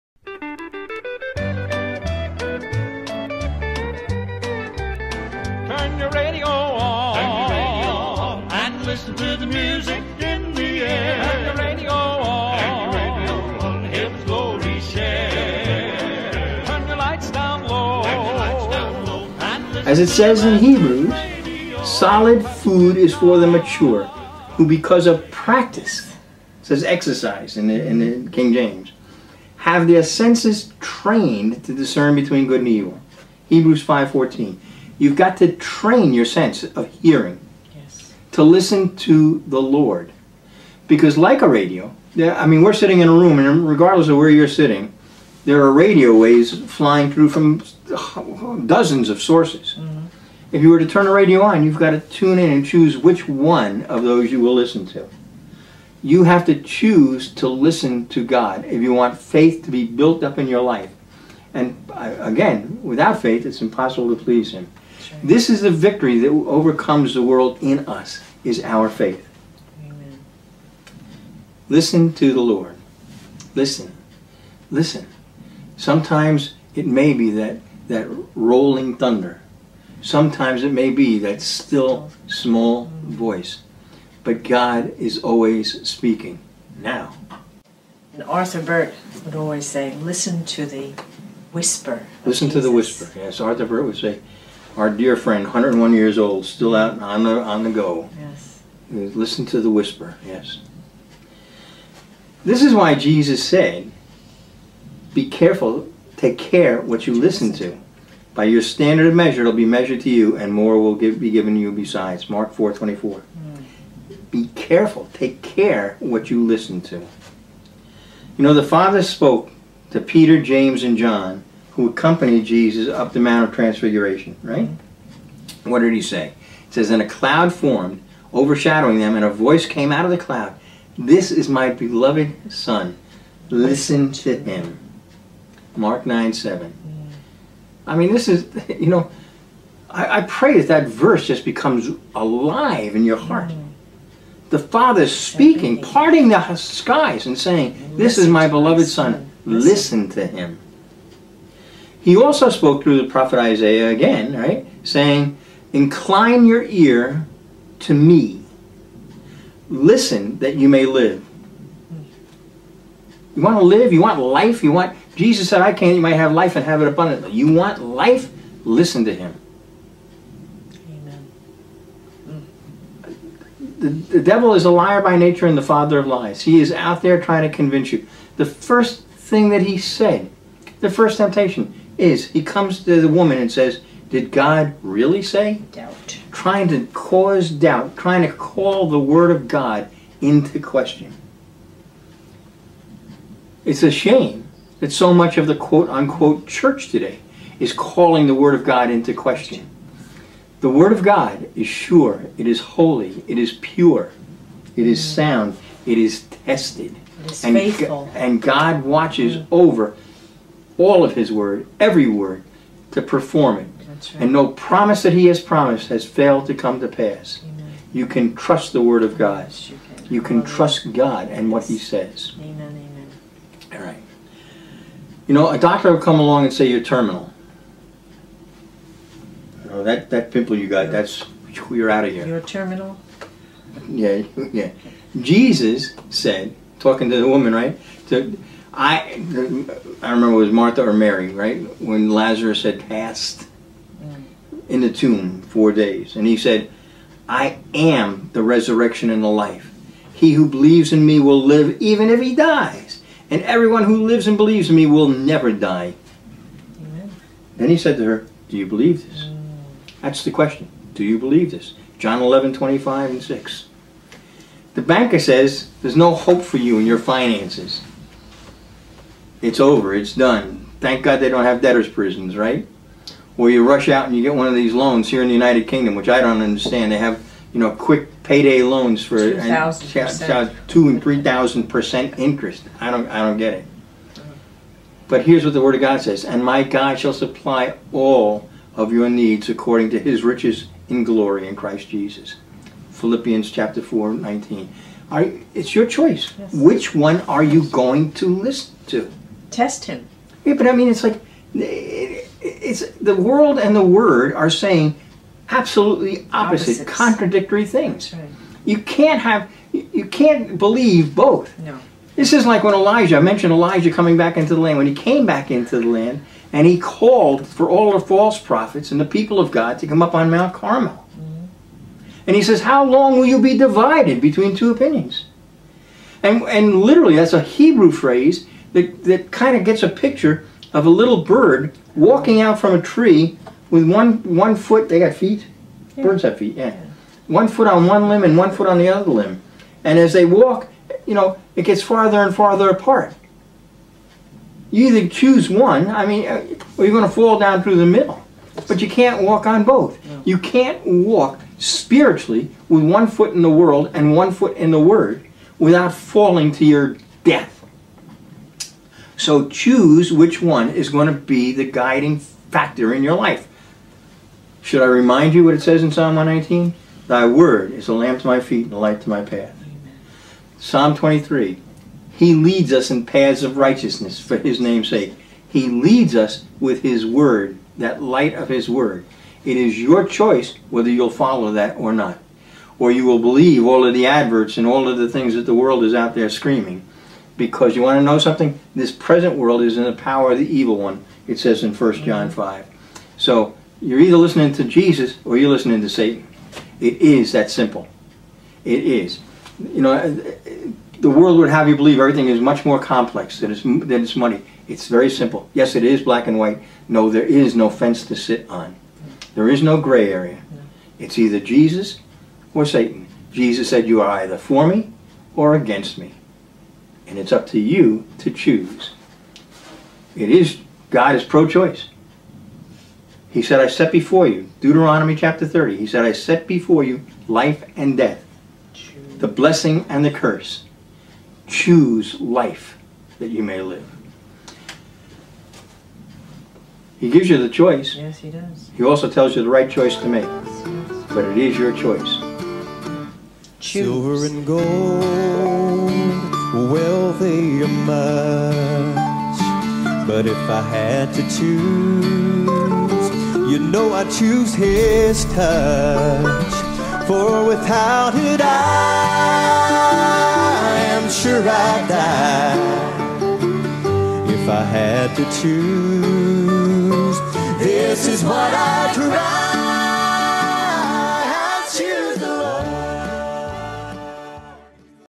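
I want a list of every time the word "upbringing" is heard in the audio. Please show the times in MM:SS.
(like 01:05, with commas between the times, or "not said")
not said.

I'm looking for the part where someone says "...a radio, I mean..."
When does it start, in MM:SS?
00:41.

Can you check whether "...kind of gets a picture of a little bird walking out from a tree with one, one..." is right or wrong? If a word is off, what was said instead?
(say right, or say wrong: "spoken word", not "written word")
right.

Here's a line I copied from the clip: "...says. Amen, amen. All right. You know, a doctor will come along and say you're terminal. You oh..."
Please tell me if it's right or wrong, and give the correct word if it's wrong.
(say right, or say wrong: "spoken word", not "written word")
right.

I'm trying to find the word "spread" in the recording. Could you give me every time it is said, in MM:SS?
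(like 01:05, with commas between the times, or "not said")
not said.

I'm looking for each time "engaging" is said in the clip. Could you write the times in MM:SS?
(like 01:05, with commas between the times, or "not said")
not said.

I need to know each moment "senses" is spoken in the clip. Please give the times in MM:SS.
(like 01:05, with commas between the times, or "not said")
00:30, 00:36.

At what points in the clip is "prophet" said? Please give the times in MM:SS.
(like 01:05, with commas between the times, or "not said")
02:33, 05:18.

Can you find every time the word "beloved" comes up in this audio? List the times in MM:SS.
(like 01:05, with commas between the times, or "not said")
02:11, 02:28.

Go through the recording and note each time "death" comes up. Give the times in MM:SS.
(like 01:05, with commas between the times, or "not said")
05:57, 07:07.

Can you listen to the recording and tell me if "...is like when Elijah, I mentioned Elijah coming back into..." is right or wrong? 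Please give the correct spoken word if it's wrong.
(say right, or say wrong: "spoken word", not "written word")
right.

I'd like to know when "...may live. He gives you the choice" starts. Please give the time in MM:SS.
07:13.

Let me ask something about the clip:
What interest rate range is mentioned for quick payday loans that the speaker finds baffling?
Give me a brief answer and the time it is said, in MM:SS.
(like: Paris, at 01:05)
2,000 to 3,000 percent, at 04:40.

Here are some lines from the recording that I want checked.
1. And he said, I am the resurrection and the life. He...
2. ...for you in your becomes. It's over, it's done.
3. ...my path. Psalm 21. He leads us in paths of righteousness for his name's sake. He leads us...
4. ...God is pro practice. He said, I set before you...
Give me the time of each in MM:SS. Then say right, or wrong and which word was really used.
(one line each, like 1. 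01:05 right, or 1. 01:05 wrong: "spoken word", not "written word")
1. 04:06 right
2. 04:26 wrong: "finances", not "becomes"
3. 06:09 wrong: "23", not "21"
4. 07:00 wrong: "choice", not "practice".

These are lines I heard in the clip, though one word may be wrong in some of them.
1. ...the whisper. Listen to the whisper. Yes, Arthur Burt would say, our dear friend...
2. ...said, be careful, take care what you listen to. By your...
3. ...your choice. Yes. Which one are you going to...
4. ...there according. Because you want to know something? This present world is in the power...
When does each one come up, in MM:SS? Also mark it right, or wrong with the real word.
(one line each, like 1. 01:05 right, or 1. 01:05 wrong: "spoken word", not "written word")
1. 01:30 right
2. 01:43 right
3. 04:55 right
4. 06:26 wrong: "screaming", not "according".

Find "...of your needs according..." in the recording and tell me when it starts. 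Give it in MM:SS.
04:48.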